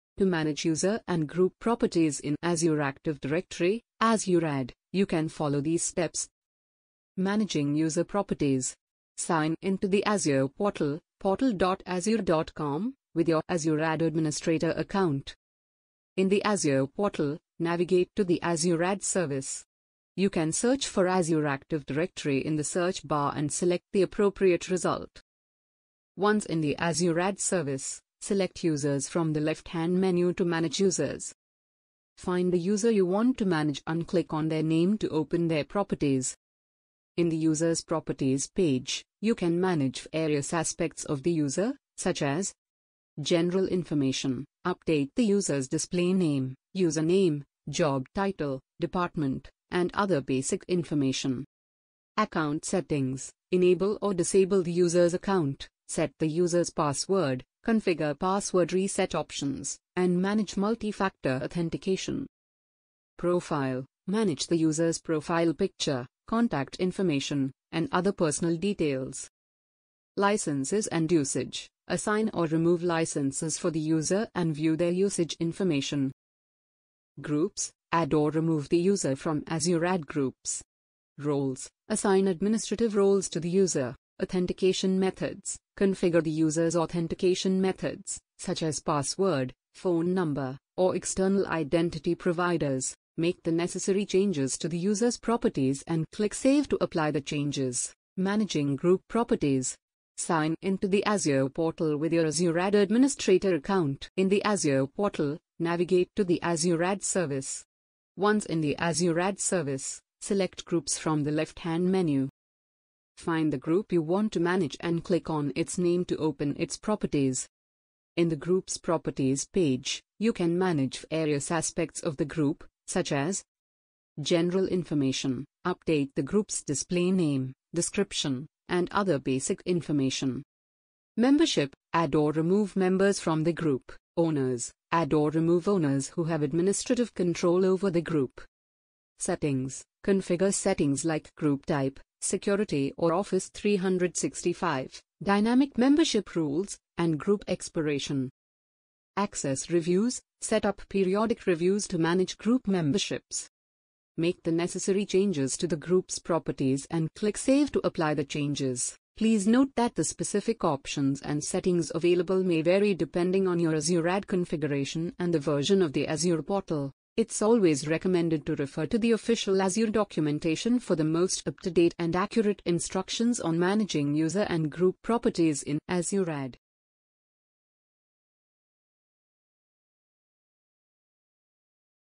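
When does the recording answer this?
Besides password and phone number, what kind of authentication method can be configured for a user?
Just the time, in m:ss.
1:30.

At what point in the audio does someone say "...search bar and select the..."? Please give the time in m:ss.
0:22.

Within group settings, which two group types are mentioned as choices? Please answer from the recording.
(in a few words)
Security or Office 365.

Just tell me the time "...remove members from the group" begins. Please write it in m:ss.
2:12.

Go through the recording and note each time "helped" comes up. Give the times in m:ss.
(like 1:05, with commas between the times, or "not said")
not said.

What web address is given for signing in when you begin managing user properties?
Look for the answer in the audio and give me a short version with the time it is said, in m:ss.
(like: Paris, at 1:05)
portal.azure.com, at 0:11.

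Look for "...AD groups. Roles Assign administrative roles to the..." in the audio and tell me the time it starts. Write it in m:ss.
1:19.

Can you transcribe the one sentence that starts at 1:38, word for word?
Managing Group Properties Sign into the Azure portal with your Azure AD administrator account.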